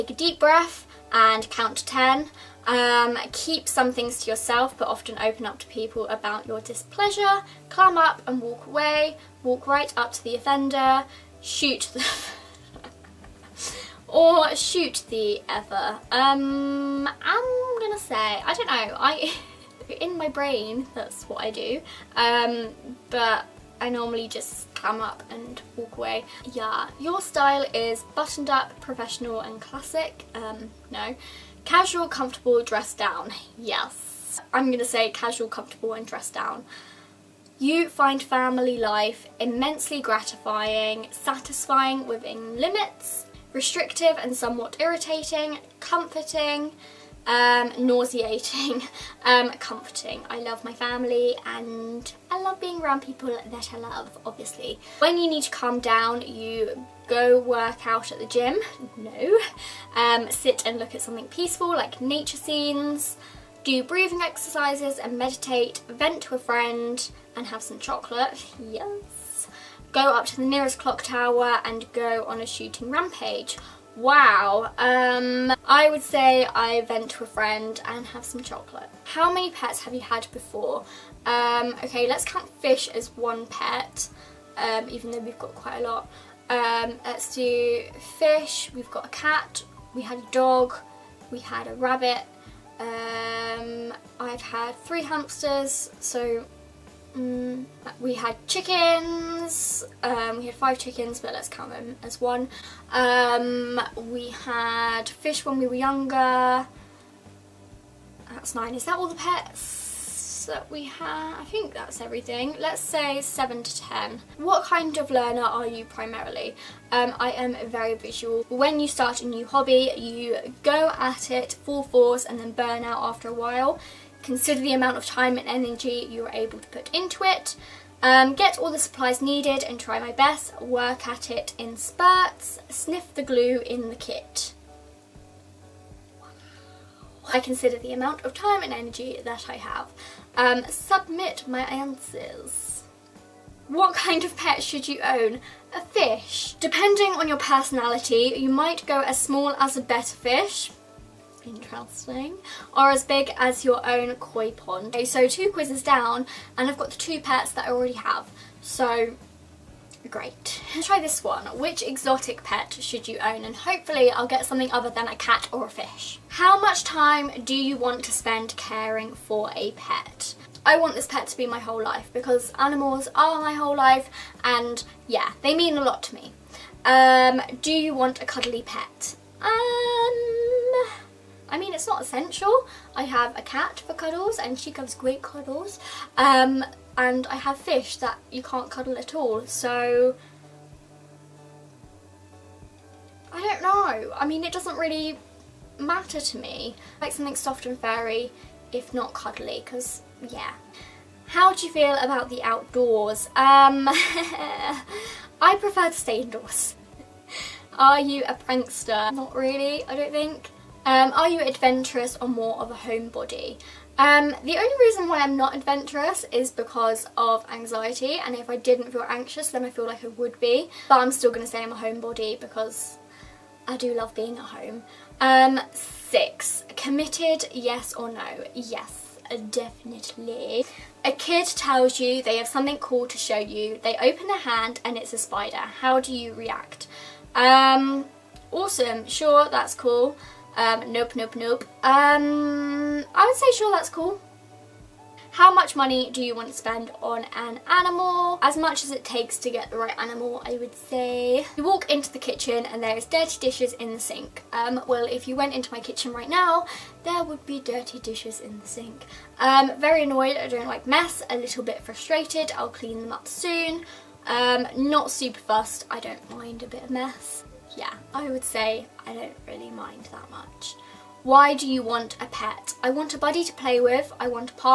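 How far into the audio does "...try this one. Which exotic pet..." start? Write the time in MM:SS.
02:40.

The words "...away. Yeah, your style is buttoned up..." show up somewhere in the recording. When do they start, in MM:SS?
00:25.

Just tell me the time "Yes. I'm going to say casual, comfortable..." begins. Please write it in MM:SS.
00:33.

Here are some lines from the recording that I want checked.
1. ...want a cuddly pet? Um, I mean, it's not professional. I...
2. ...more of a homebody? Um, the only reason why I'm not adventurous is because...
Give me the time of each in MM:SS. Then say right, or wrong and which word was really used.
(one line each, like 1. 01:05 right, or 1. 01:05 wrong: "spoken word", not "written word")
1. 02:57 wrong: "essential", not "professional"
2. 03:32 right.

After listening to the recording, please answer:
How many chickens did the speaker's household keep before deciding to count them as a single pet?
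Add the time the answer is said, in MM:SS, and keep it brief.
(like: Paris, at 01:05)
5, at 01:40.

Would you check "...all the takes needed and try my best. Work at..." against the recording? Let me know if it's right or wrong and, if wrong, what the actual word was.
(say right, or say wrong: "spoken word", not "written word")
wrong: "supplies", not "takes".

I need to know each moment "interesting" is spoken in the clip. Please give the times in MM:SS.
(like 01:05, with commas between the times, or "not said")
02:31.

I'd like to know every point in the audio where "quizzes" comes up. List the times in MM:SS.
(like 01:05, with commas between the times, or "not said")
02:35.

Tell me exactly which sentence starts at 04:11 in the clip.
You walk into the kitchen and there's dirty dishes in the sink.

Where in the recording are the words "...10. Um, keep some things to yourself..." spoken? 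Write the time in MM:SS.
00:01.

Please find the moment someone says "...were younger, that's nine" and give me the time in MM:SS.
01:45.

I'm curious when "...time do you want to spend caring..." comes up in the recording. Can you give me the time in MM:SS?
02:46.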